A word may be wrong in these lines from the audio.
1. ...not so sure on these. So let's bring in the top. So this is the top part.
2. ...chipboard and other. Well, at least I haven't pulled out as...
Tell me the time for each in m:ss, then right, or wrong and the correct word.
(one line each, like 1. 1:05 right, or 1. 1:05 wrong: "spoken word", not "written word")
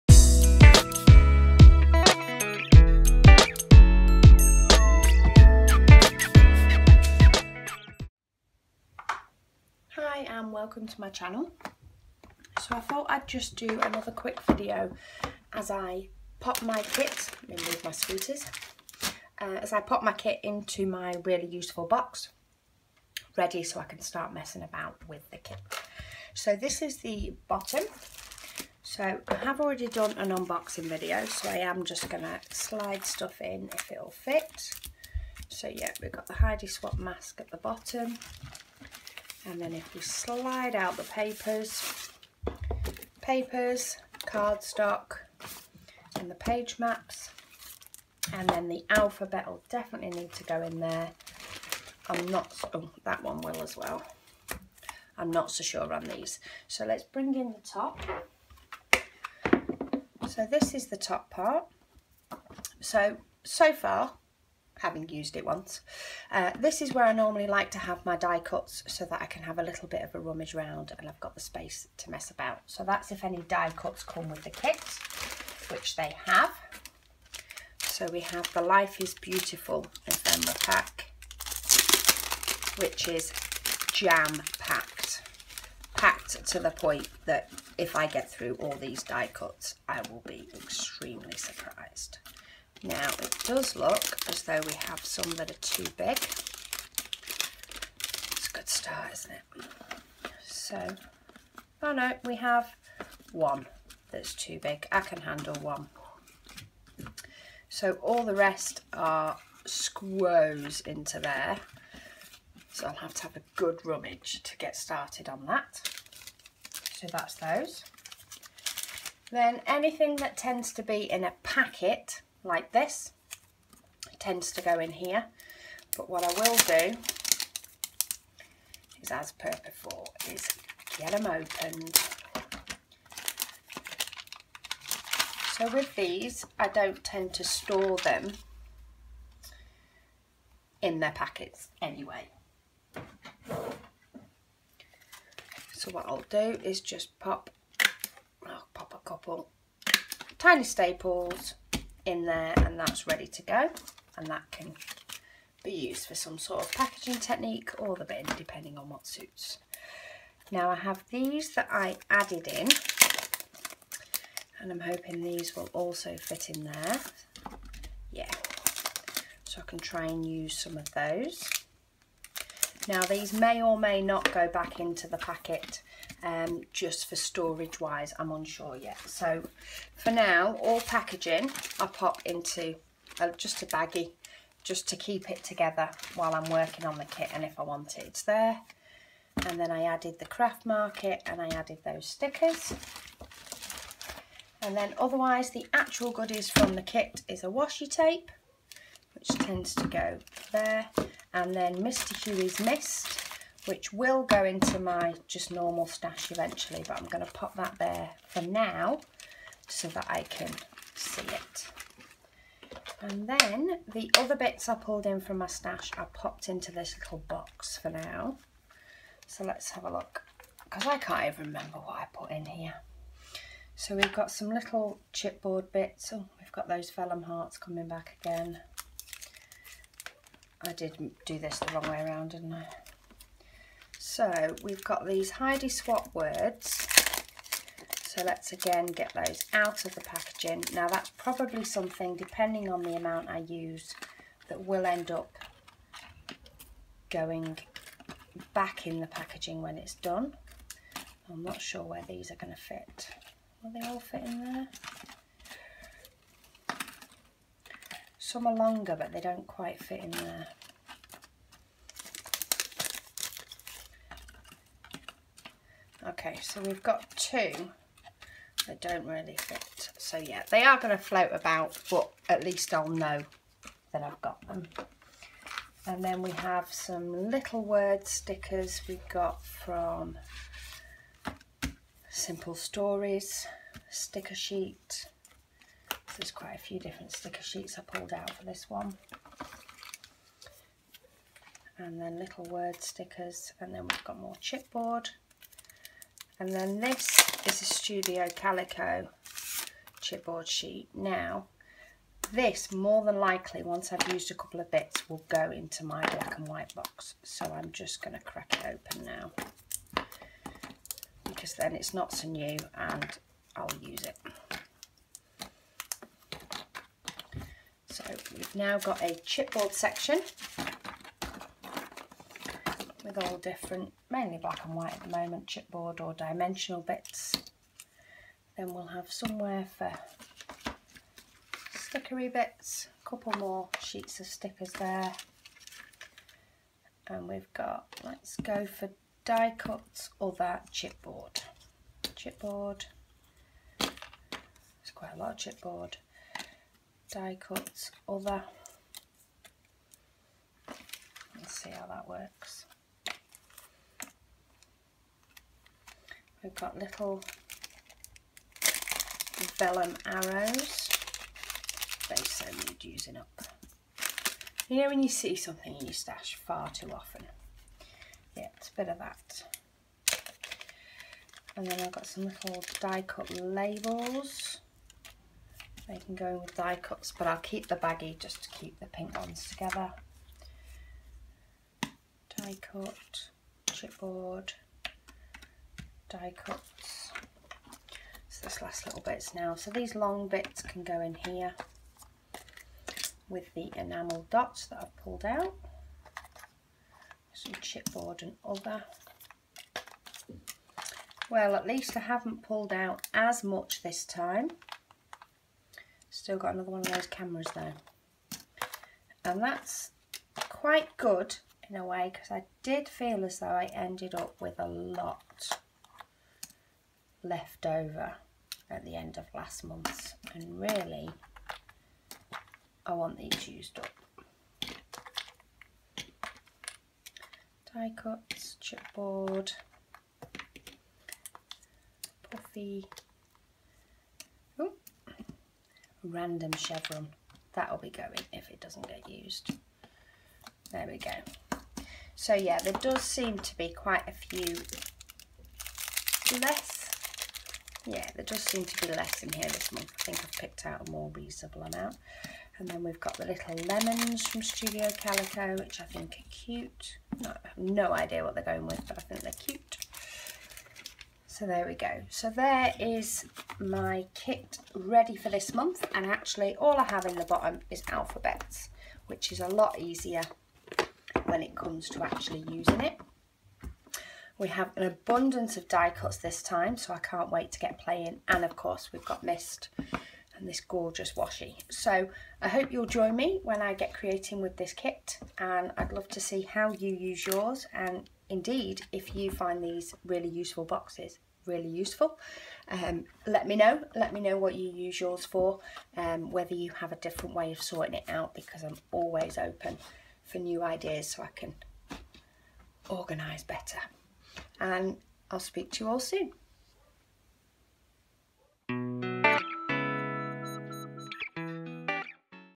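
1. 0:55 right
2. 6:37 right.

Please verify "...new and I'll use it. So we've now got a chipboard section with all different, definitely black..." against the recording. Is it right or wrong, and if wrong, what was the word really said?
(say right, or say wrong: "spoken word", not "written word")
wrong: "mainly", not "definitely".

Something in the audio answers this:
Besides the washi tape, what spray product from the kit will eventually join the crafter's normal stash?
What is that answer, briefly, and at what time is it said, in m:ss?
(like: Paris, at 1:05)
Mr Huey's Mist, at 3:21.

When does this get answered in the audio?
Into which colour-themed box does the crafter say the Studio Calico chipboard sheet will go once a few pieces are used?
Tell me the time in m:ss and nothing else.
5:06.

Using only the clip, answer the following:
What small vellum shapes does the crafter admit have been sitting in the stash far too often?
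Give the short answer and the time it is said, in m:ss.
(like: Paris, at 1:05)
arrows, at 5:59.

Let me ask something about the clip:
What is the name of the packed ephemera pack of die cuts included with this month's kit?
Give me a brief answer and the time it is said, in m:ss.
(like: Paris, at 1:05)
Life is Beautiful, at 1:18.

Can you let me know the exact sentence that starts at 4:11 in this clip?
I'm not sure where these are going to fit.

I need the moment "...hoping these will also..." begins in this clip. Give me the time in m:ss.
2:44.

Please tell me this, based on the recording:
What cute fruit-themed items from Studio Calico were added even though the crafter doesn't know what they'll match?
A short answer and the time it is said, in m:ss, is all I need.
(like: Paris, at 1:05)
lemons, at 7:33.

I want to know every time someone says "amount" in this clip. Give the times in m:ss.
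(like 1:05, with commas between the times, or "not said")
4:02, 7:31.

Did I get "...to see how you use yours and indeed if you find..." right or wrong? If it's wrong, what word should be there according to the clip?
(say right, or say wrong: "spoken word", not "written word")
right.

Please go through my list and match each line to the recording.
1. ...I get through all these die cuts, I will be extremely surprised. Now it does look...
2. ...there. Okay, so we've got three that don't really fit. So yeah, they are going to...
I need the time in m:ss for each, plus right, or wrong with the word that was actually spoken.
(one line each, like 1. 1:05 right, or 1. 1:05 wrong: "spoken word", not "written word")
1. 1:27 right
2. 4:20 wrong: "two", not "three".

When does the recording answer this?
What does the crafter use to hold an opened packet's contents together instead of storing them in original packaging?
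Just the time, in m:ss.
2:30.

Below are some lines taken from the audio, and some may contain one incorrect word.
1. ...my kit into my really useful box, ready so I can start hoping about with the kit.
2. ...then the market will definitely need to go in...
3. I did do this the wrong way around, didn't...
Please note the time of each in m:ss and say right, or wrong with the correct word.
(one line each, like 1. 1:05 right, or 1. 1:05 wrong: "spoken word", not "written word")
1. 0:20 wrong: "messing", not "hoping"
2. 0:48 wrong: "alphabet", not "market"
3. 3:50 right.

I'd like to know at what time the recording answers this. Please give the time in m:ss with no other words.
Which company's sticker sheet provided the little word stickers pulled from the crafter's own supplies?
4:42.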